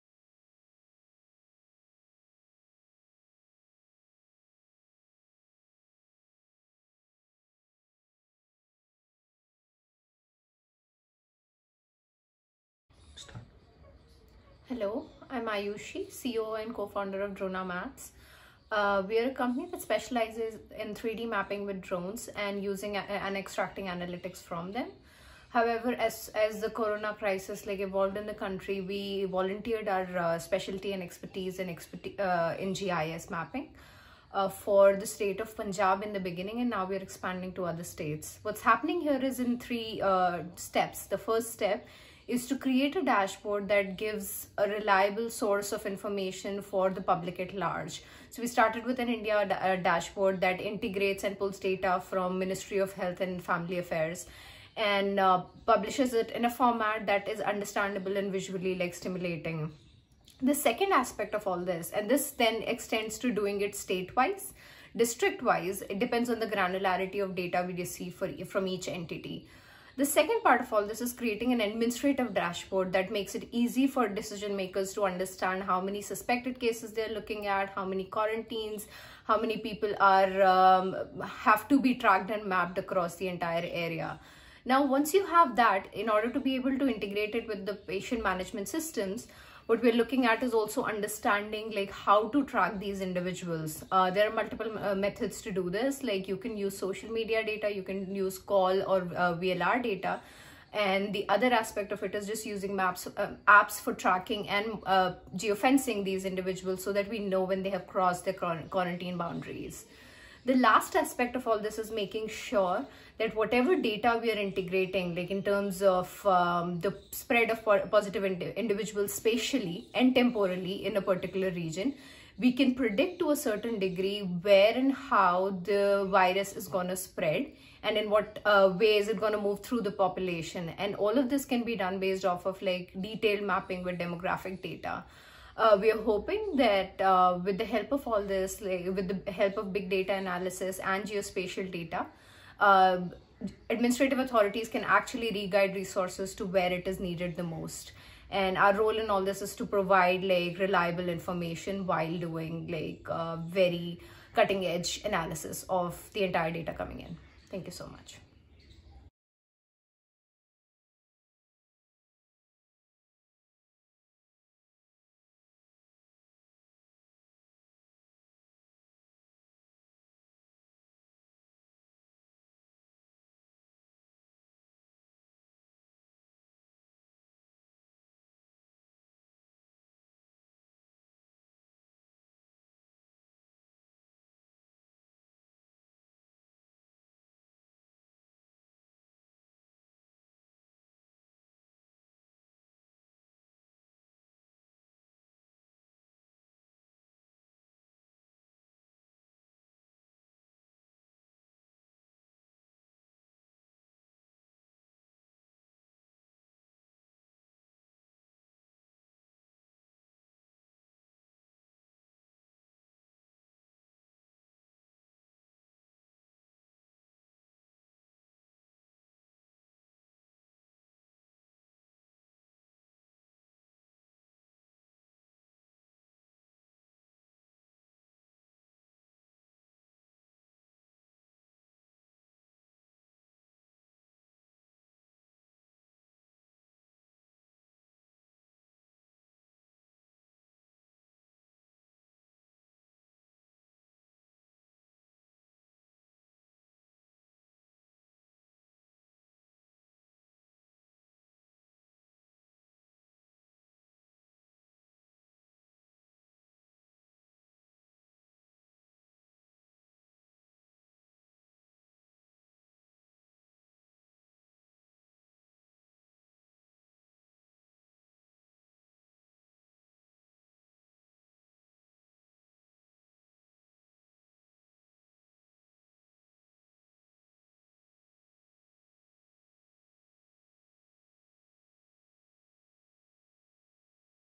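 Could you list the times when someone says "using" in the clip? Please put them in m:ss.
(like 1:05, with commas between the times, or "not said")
0:22, 1:42.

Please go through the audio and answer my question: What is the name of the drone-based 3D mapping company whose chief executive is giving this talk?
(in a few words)
DronaMaps.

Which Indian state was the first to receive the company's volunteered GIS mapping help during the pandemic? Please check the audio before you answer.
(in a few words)
Punjab.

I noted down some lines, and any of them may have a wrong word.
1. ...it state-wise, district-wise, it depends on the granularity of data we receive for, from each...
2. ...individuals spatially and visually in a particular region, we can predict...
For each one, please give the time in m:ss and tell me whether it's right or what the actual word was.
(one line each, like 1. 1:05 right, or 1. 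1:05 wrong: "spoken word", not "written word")
1. 1:03 right
2. 1:58 wrong: "temporally", not "visually".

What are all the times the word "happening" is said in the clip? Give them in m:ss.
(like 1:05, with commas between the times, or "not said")
0:38.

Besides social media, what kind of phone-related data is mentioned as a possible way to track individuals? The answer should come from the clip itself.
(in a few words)
VLR data.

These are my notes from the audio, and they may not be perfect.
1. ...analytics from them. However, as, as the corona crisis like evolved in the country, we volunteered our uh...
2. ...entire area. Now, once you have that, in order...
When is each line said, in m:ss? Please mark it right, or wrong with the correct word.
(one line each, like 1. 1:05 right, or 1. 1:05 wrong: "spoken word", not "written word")
1. 0:23 right
2. 1:23 right.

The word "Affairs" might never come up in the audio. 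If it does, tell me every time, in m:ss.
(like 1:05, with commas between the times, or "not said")
0:53.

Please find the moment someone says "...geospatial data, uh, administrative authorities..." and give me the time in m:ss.
2:21.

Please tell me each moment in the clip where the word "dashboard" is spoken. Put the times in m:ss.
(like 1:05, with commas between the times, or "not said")
0:43, 0:49, 1:12.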